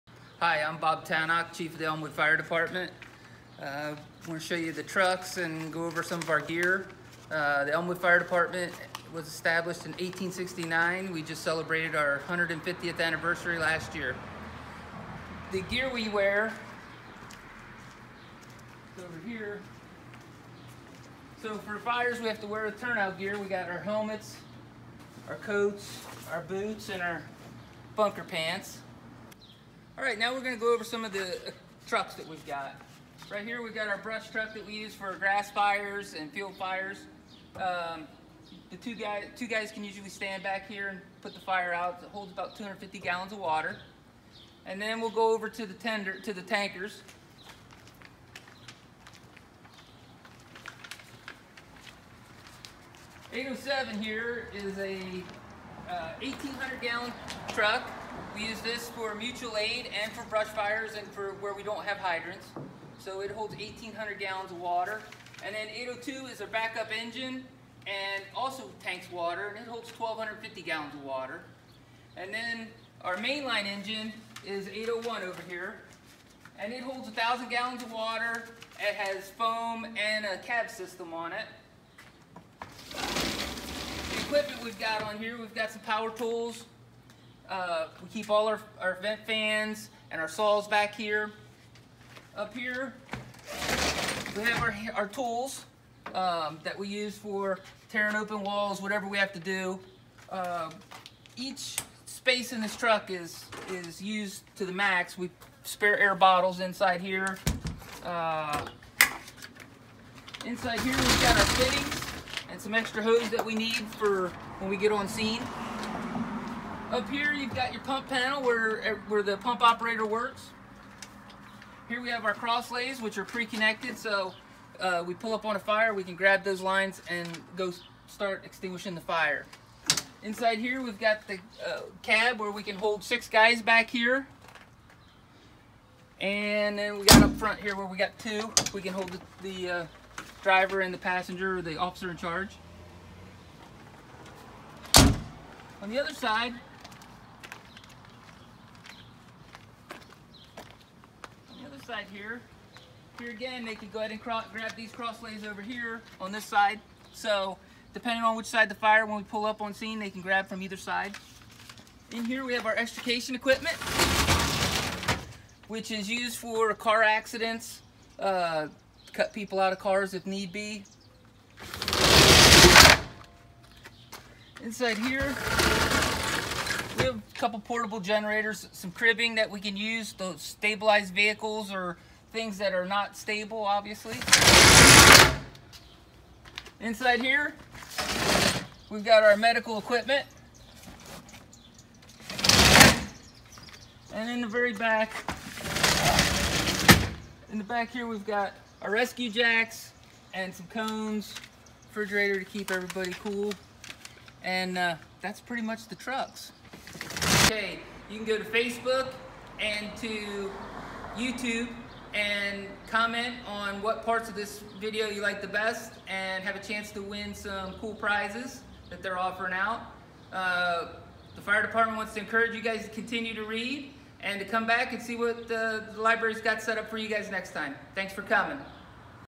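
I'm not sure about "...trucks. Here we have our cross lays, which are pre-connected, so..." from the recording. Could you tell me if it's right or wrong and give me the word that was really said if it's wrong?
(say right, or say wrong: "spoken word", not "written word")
wrong: "works", not "trucks".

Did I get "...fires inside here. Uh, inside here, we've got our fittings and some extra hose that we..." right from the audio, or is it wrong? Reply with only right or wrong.
wrong.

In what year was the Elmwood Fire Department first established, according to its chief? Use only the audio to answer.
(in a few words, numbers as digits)
1869.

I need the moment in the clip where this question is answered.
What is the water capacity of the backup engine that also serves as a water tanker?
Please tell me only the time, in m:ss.
1:09.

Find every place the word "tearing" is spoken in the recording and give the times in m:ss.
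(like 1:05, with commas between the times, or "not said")
1:37.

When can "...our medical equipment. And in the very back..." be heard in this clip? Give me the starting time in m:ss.
3:09.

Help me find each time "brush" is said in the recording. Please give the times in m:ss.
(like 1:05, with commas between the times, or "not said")
0:33, 1:00.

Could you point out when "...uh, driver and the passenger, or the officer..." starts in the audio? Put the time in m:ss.
2:19.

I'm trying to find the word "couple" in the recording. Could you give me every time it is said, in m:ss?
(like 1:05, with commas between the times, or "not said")
2:57.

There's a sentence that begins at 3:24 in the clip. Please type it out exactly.
And uh, that's pretty much the trucks.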